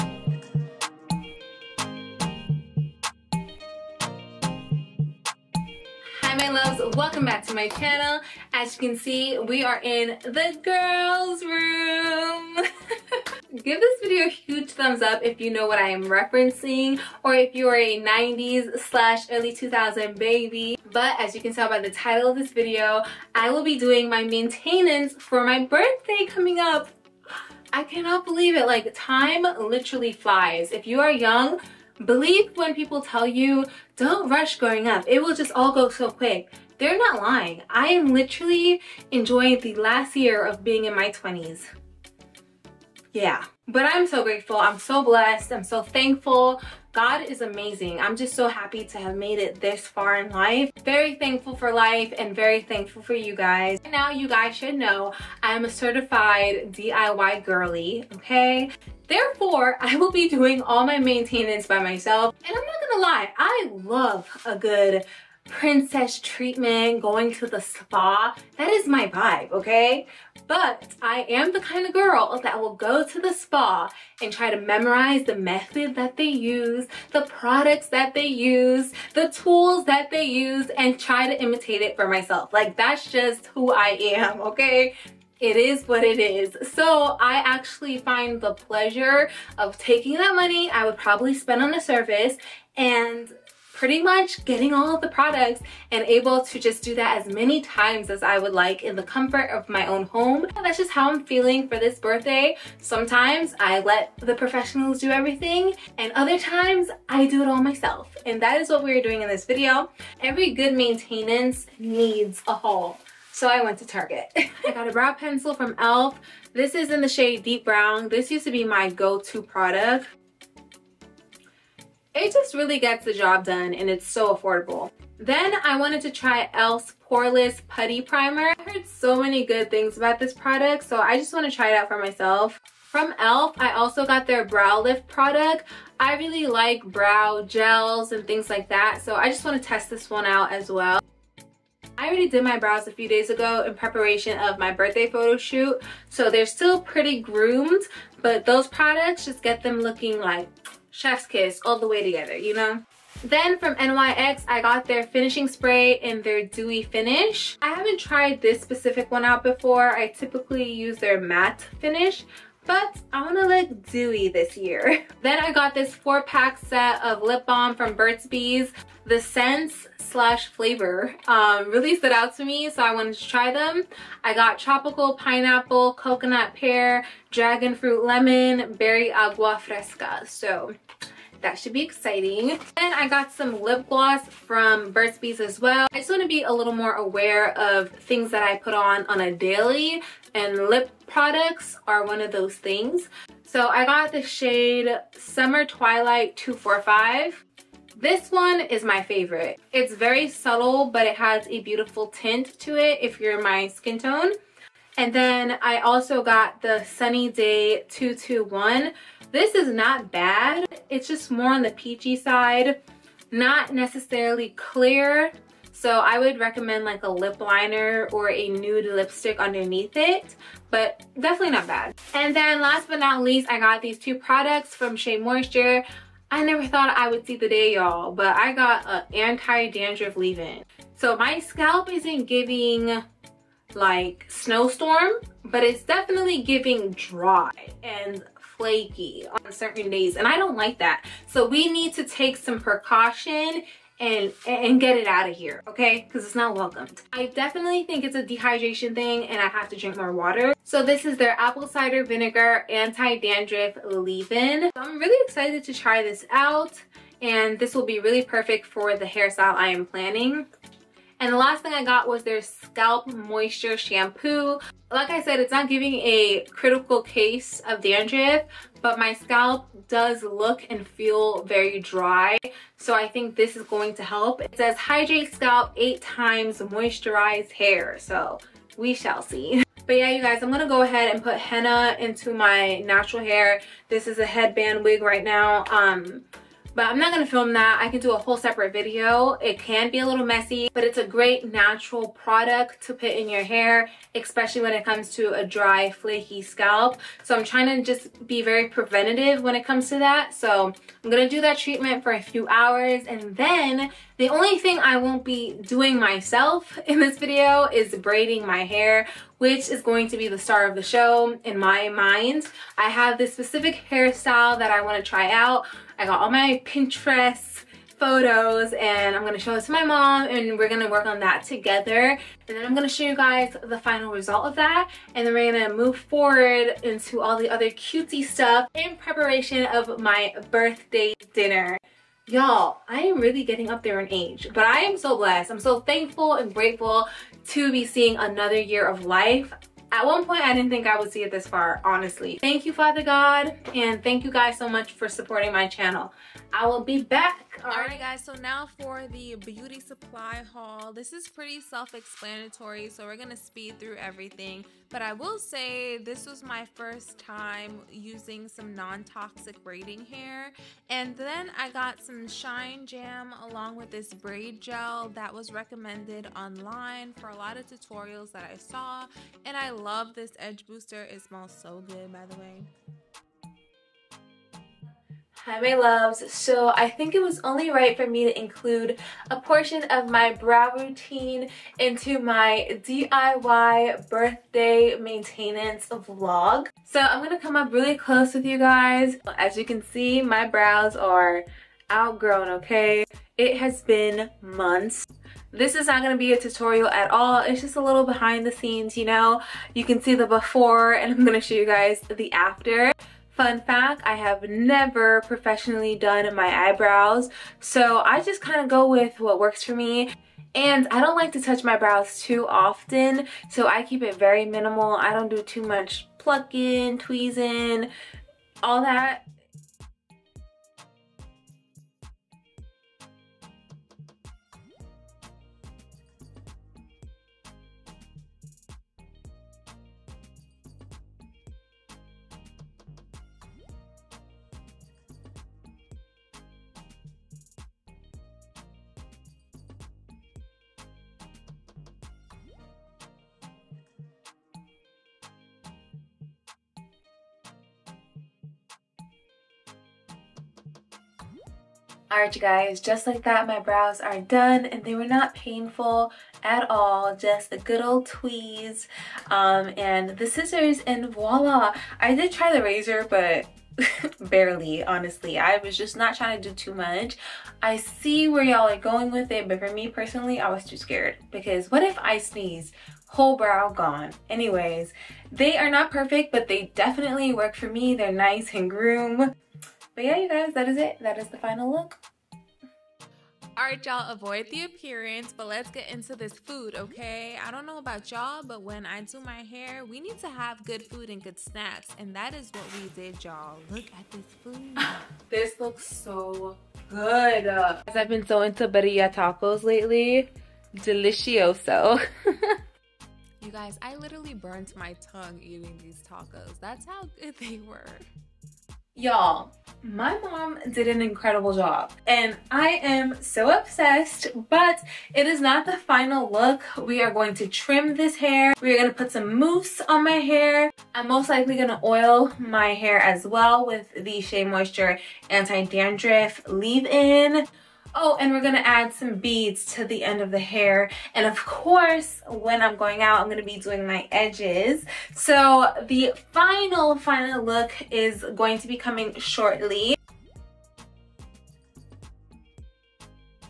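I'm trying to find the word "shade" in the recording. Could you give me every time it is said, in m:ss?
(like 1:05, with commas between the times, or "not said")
1:57, 3:14.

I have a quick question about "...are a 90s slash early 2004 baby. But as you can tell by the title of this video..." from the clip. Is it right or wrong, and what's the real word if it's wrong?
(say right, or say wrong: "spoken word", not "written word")
wrong: "2000", not "2004".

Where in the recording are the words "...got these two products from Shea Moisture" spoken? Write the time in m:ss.
3:43.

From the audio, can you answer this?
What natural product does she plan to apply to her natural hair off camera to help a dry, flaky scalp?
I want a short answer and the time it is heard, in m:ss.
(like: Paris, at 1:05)
henna, at 4:41.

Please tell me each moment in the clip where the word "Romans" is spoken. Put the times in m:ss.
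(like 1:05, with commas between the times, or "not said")
not said.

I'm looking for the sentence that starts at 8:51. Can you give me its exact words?
And of course, when I'm going out, I'm gonna be doing my edges.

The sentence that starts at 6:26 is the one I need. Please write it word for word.
So I'm going to come up really close with you guys.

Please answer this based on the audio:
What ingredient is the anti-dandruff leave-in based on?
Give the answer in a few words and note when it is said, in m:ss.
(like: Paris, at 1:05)
apple cider vinegar, at 4:11.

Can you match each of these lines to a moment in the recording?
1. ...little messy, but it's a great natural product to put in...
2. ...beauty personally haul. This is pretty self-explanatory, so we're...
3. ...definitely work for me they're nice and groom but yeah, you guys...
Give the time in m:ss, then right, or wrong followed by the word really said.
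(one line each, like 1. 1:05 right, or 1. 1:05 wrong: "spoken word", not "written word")
1. 4:50 right
2. 5:49 wrong: "supply", not "personally"
3. 7:56 right.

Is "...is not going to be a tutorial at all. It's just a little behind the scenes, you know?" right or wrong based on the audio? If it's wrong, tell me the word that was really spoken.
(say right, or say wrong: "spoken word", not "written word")
right.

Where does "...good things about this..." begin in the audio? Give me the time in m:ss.
2:09.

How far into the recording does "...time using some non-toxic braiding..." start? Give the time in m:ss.
5:57.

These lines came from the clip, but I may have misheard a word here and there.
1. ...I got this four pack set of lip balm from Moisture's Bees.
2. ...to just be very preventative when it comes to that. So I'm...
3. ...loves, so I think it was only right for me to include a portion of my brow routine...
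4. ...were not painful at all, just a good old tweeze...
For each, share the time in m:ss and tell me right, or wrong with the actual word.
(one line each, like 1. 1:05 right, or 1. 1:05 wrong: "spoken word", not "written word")
1. 2:45 wrong: "Burt", not "Moisture"
2. 4:57 right
3. 6:15 right
4. 7:34 right.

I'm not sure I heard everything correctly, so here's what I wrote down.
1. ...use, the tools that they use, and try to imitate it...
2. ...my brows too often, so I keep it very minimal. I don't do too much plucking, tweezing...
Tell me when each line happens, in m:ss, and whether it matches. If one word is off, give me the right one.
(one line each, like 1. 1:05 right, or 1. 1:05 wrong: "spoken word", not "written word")
1. 1:18 right
2. 6:51 right.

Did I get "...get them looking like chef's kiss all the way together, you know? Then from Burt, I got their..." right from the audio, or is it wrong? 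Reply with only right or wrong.
wrong.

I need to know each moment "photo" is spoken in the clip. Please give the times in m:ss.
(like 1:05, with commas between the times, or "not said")
2:25, 5:17.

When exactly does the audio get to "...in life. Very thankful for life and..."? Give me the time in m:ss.
0:50.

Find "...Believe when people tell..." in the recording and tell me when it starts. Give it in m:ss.
0:32.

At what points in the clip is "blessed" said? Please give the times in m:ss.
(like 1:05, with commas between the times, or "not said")
0:45, 5:35.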